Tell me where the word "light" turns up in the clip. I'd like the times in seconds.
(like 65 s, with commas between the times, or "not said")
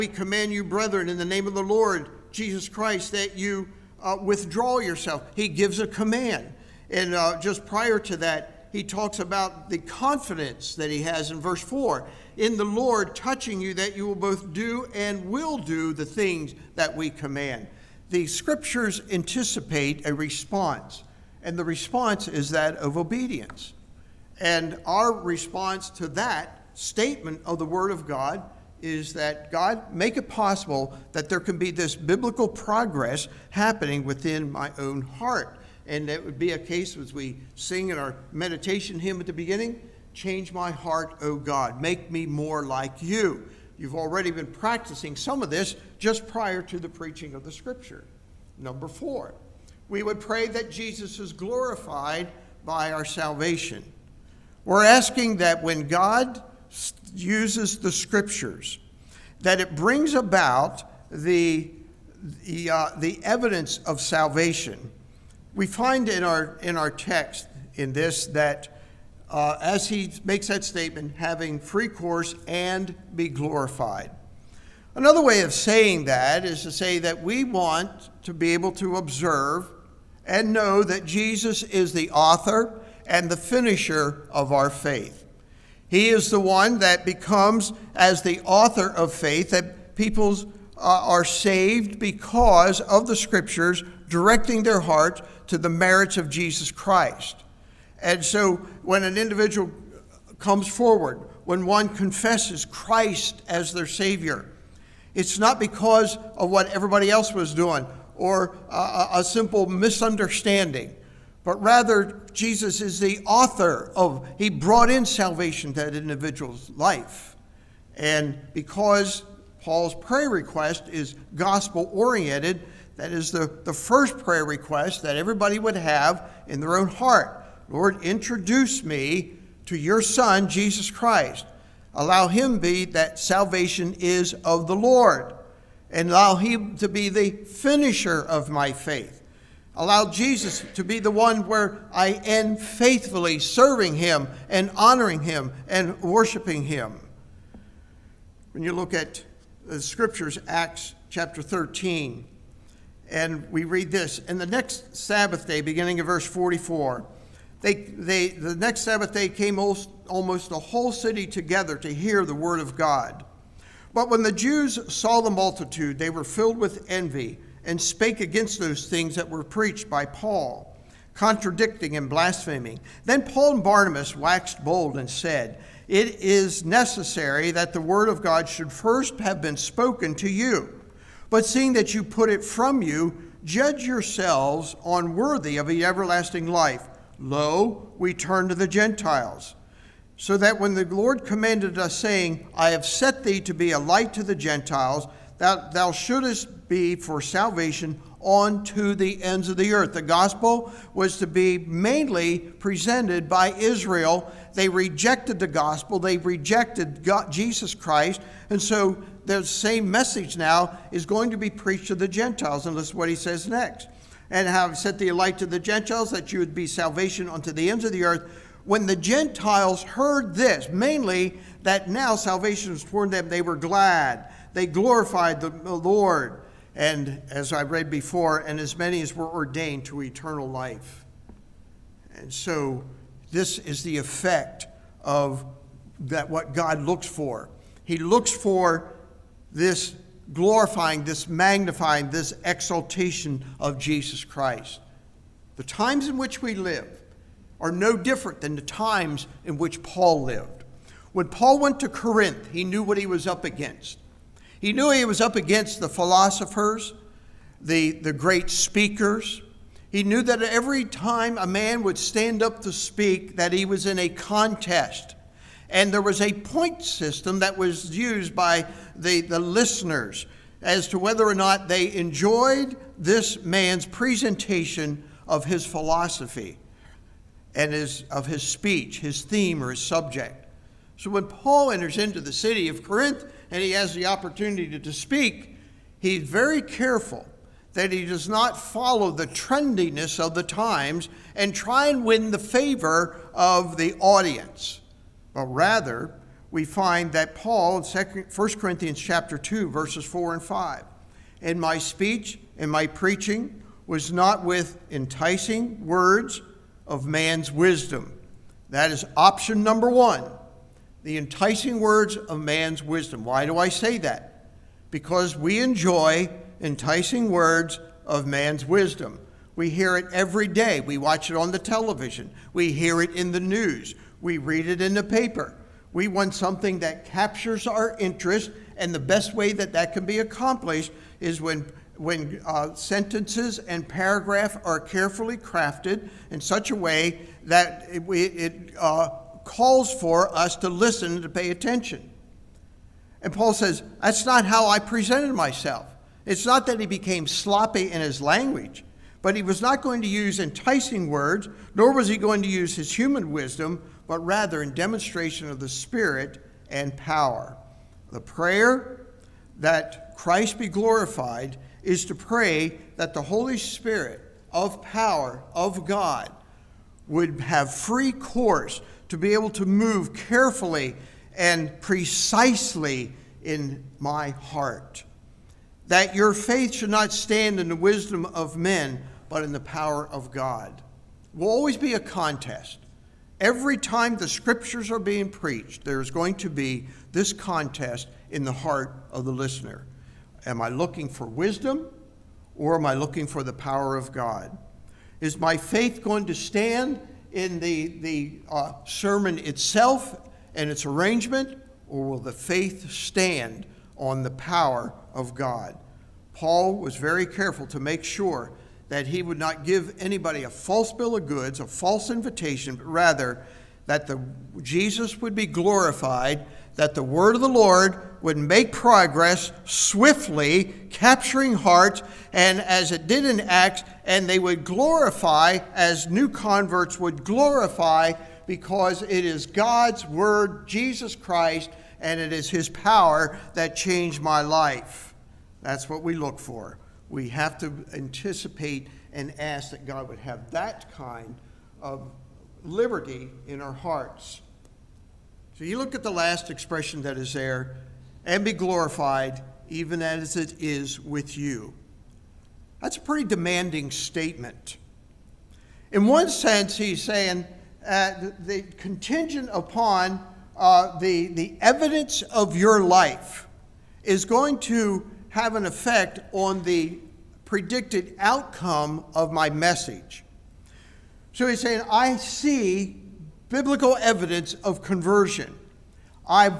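193 s, 215 s.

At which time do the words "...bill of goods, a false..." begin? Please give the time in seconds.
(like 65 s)
410 s.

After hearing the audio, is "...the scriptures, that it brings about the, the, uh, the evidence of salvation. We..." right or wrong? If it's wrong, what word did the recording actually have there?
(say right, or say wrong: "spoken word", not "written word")
right.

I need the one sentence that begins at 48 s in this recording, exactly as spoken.
Number four, we would pray that Jesus is glorified by our salvation.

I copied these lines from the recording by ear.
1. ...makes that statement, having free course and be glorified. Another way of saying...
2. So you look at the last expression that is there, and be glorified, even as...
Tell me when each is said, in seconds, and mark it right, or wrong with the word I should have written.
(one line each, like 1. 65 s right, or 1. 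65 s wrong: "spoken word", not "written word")
1. 70 s right
2. 445 s right.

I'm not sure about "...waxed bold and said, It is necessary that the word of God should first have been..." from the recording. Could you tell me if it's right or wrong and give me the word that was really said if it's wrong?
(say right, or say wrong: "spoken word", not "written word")
right.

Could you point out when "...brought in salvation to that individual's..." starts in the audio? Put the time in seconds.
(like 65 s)
114 s.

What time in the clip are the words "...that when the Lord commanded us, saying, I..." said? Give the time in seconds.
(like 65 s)
190 s.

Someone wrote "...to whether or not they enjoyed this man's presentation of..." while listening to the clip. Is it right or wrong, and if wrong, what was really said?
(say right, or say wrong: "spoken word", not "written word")
right.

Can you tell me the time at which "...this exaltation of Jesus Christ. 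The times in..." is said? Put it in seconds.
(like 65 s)
242 s.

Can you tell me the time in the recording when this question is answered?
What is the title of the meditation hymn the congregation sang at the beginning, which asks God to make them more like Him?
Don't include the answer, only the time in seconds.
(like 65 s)
40 s.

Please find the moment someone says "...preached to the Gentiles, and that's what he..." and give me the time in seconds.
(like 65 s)
211 s.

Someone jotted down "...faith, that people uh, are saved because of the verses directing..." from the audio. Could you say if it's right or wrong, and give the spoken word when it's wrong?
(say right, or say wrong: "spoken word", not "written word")
wrong: "scriptures", not "verses".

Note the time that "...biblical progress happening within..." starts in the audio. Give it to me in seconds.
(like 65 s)
31 s.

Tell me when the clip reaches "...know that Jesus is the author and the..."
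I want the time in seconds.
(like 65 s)
80 s.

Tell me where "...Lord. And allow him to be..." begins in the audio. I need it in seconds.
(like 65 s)
134 s.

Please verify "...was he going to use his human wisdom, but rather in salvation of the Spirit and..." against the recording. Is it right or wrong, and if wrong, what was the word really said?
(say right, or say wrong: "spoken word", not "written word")
wrong: "demonstration", not "salvation".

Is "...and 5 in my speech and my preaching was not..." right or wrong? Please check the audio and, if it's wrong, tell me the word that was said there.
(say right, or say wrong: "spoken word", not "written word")
right.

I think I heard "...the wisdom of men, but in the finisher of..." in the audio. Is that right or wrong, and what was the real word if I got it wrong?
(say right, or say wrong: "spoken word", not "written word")
wrong: "power", not "finisher".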